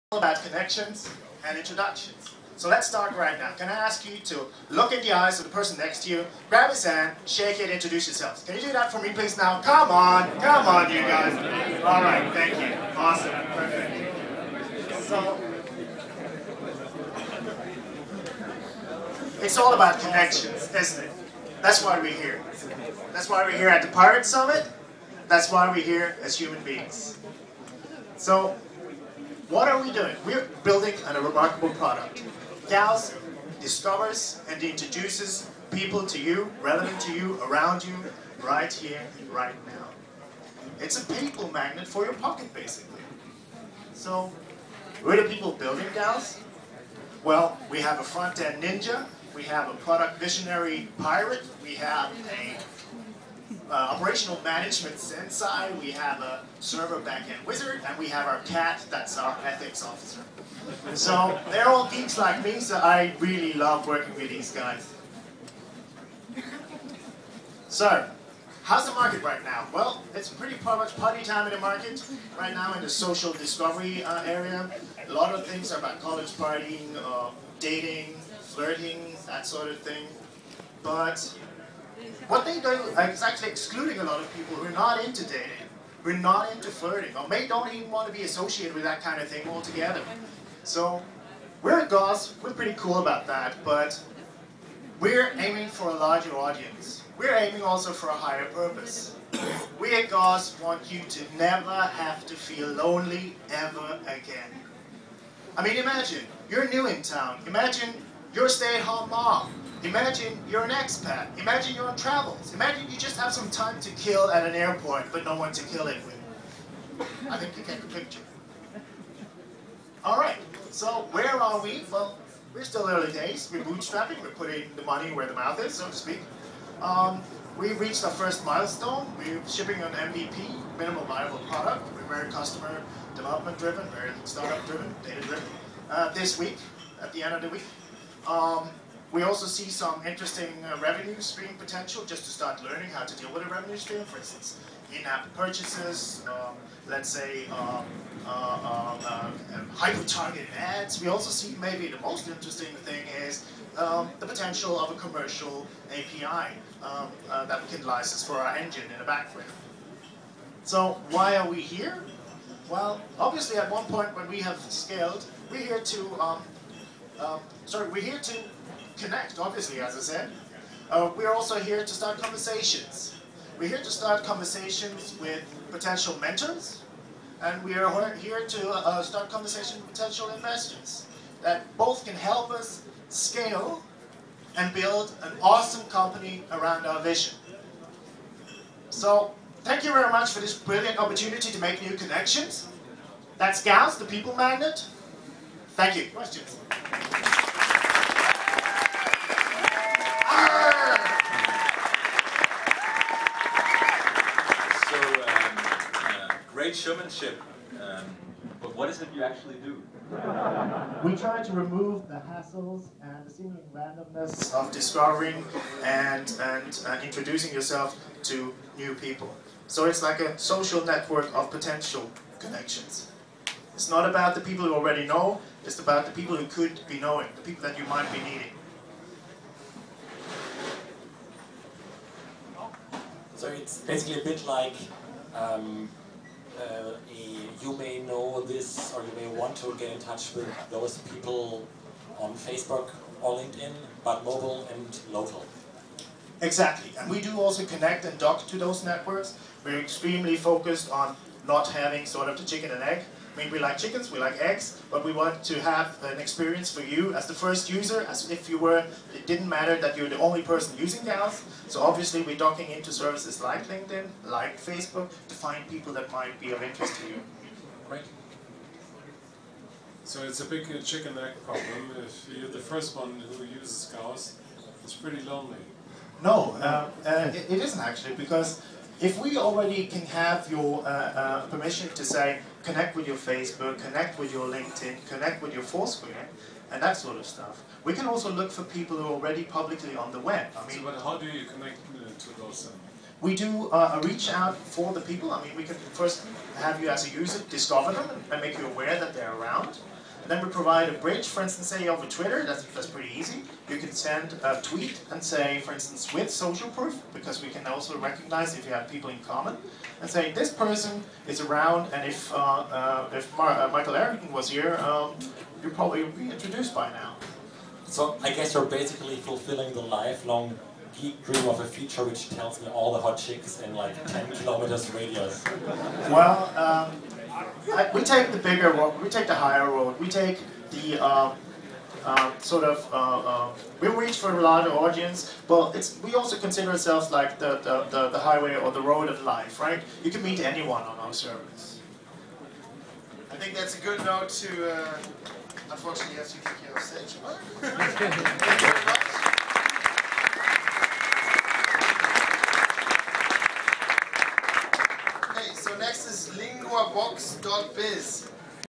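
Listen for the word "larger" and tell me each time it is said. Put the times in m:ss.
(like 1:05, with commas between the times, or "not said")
1:35, 5:34.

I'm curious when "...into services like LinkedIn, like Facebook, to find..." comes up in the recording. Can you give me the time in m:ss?
4:22.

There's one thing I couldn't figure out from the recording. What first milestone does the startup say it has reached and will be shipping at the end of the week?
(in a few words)
MVP.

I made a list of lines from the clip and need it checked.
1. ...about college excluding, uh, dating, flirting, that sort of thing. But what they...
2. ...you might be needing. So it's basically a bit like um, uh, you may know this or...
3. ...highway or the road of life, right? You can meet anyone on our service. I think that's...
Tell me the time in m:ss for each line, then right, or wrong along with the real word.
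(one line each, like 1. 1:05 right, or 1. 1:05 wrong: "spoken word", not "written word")
1. 1:15 wrong: "partying", not "excluding"
2. 3:47 right
3. 5:38 right.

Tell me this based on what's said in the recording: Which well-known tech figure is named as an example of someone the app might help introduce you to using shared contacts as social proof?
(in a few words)
Michael Arrington.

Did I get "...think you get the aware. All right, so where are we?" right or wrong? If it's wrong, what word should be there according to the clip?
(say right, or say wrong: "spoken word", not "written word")
wrong: "picture", not "aware".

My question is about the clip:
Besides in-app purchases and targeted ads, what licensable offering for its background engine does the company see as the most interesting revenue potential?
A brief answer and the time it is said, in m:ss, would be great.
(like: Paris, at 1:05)
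commercial API, at 2:34.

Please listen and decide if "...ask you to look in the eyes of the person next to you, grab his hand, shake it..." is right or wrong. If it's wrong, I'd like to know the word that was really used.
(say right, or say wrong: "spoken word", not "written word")
right.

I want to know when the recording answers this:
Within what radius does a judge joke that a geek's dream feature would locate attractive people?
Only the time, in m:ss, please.
5:24.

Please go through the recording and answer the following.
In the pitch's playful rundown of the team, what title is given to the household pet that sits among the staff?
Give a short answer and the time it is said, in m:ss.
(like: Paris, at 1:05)
ethics officer, at 0:59.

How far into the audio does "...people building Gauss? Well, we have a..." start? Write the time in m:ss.
0:45.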